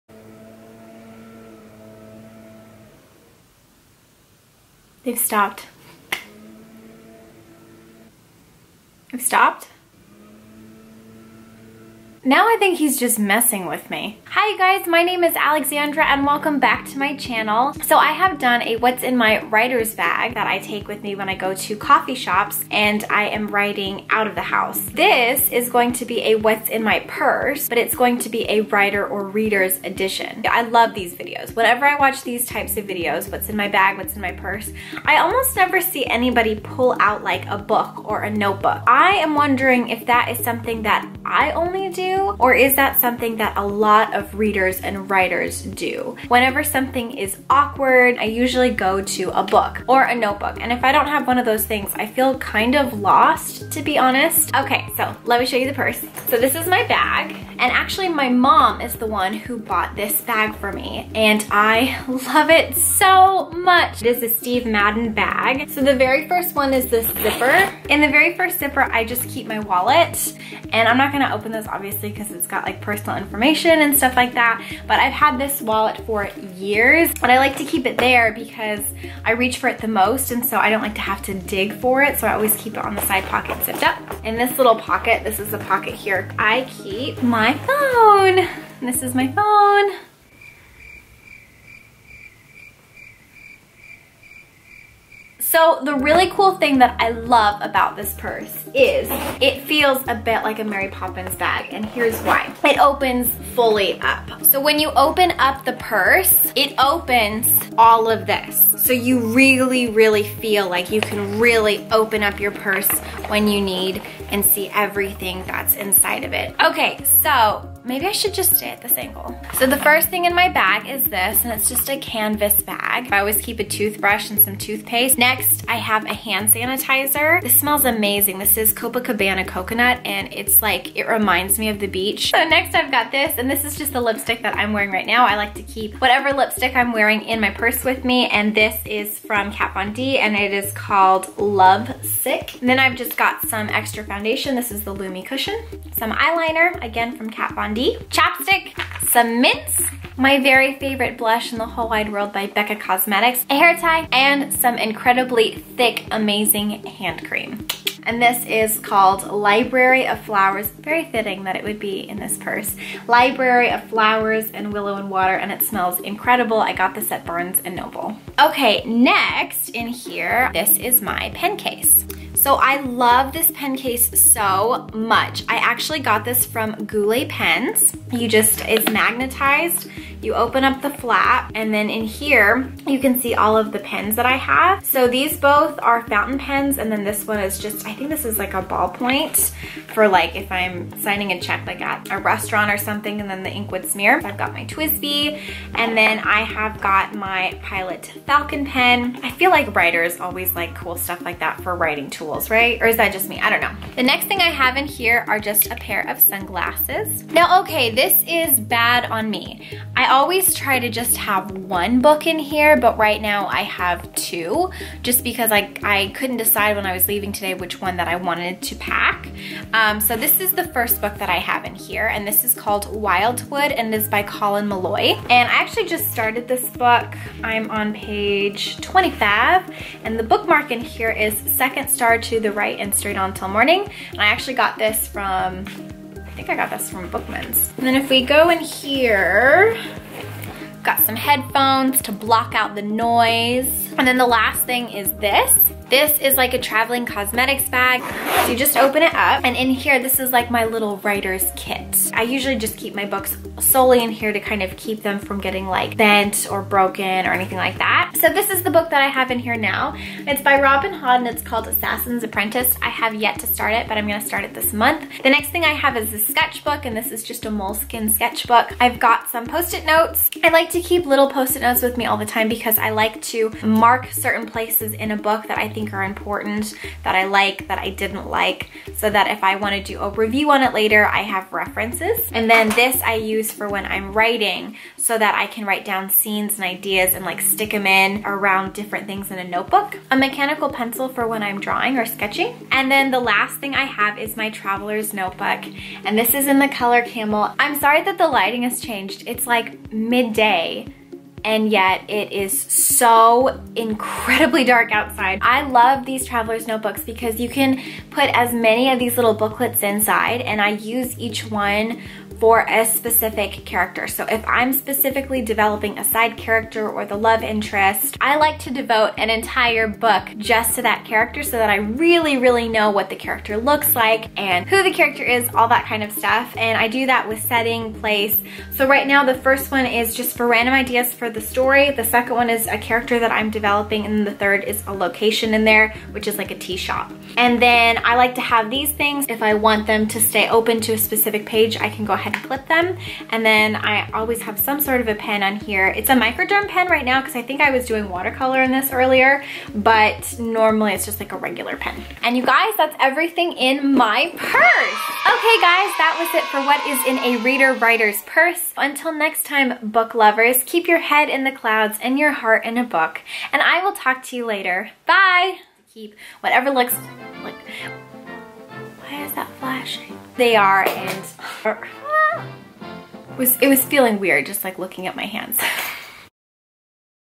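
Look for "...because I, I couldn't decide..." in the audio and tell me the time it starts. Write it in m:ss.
3:35.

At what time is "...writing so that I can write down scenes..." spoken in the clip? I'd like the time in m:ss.
4:44.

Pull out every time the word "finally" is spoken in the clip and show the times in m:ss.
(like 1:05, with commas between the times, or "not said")
not said.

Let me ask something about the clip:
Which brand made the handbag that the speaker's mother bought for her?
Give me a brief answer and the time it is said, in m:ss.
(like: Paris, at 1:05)
Steve Madden, at 1:04.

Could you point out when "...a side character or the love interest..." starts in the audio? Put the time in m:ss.
5:15.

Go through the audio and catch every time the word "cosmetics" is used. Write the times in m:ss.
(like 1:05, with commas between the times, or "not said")
2:32, 4:07.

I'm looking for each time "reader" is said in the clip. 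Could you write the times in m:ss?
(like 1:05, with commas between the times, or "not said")
0:29, 0:44, 5:57.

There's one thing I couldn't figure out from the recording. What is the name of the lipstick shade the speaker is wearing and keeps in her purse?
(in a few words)
Love Sick.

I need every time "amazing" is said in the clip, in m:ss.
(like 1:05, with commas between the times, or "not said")
2:07, 2:36.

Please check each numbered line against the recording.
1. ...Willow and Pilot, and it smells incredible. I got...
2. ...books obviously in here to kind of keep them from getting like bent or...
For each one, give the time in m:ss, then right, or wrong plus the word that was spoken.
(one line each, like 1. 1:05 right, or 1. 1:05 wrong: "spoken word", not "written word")
1. 2:44 wrong: "Water", not "Pilot"
2. 4:13 wrong: "solely", not "obviously".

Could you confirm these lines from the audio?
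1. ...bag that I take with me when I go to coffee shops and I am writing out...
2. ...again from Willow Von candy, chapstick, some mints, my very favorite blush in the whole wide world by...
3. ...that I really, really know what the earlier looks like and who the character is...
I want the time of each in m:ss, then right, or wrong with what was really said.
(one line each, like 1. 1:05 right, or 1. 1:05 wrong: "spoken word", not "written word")
1. 0:19 right
2. 2:26 wrong: "Kat", not "Willow"
3. 5:21 wrong: "character", not "earlier".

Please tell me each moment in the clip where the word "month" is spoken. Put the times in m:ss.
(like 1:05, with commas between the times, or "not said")
4:24.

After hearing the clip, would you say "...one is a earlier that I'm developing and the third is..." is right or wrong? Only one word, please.
wrong.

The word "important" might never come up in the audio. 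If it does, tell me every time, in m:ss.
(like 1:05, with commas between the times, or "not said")
4:36.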